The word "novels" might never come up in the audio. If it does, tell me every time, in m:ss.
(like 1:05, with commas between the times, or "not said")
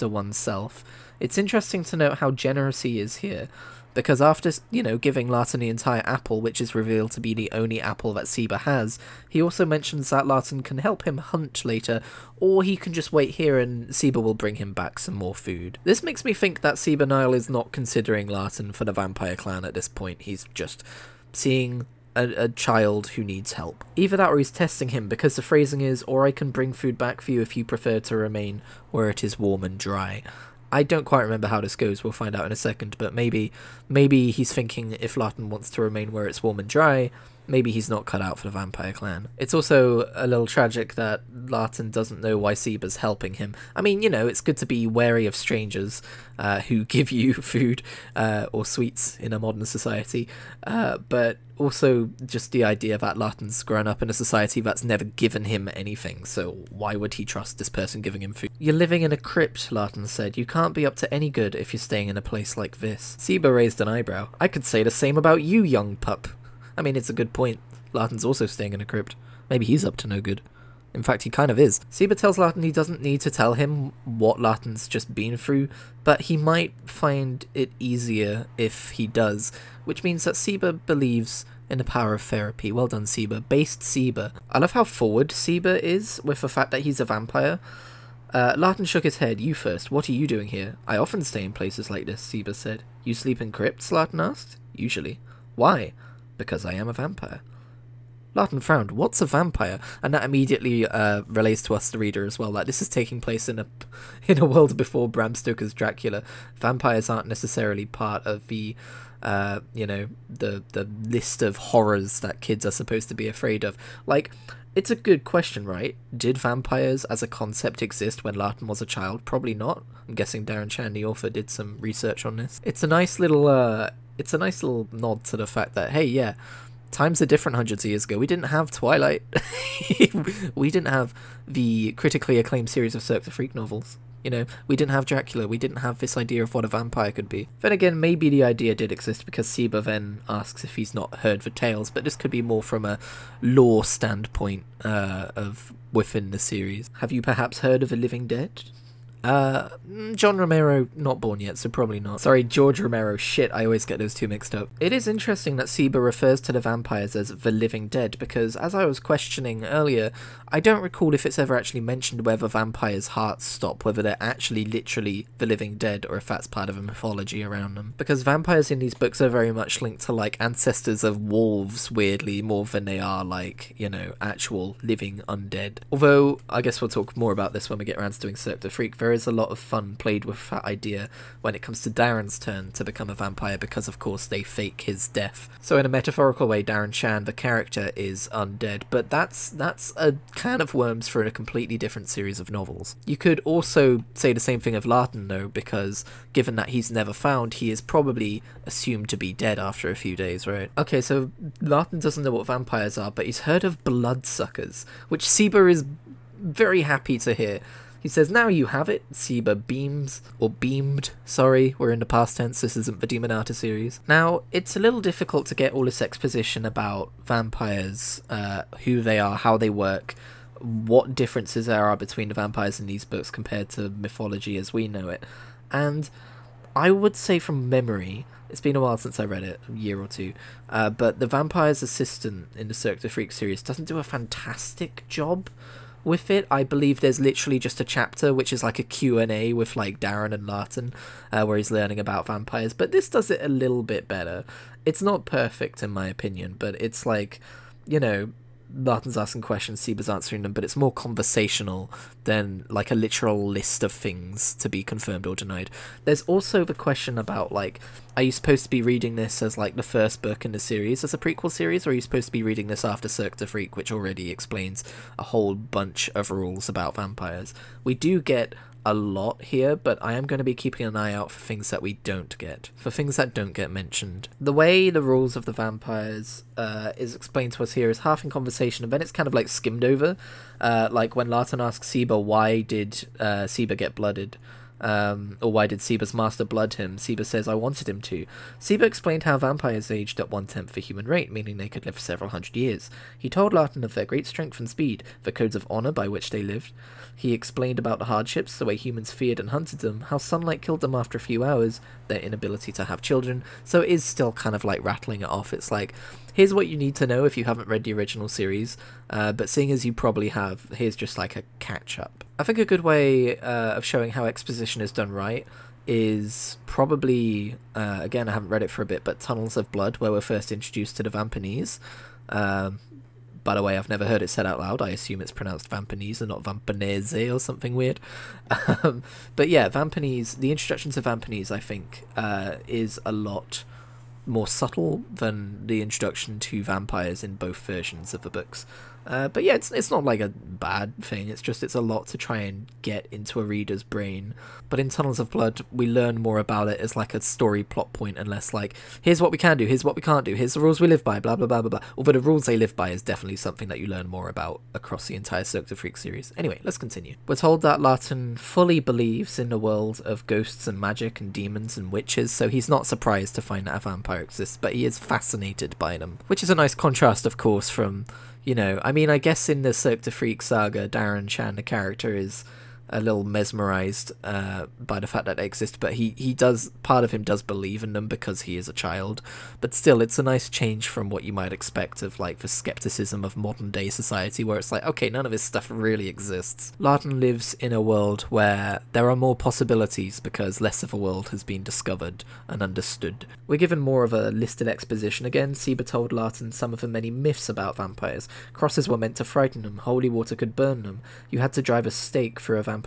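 2:13, 3:12.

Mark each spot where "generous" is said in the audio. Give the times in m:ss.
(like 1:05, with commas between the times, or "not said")
0:02.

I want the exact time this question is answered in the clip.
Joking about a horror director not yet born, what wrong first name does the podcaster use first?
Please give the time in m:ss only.
2:30.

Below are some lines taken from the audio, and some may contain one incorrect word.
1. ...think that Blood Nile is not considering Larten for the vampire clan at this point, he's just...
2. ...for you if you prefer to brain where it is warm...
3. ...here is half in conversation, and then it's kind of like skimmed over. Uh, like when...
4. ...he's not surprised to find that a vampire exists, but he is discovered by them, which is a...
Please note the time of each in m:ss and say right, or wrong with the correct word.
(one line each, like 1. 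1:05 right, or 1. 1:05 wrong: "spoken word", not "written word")
1. 0:16 wrong: "Seba", not "Blood"
2. 0:27 wrong: "remain", not "brain"
3. 4:37 right
4. 6:02 wrong: "fascinated", not "discovered".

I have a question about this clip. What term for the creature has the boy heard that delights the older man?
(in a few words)
bloodsuckers.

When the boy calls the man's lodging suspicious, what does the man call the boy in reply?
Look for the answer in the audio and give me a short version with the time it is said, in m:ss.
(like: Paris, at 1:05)
young pup, at 1:05.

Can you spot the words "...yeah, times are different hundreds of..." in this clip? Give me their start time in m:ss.
2:06.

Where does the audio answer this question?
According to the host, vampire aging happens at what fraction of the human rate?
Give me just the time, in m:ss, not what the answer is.
4:50.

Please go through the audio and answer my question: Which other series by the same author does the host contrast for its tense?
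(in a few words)
Demonata.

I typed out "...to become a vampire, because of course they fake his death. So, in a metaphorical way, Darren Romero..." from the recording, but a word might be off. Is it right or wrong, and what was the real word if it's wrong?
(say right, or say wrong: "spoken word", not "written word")
wrong: "Shan", not "Romero".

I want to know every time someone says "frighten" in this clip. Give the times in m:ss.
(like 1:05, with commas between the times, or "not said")
6:39.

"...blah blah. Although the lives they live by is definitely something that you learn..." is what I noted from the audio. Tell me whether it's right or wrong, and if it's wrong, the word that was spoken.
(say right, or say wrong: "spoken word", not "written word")
wrong: "rules", not "lives".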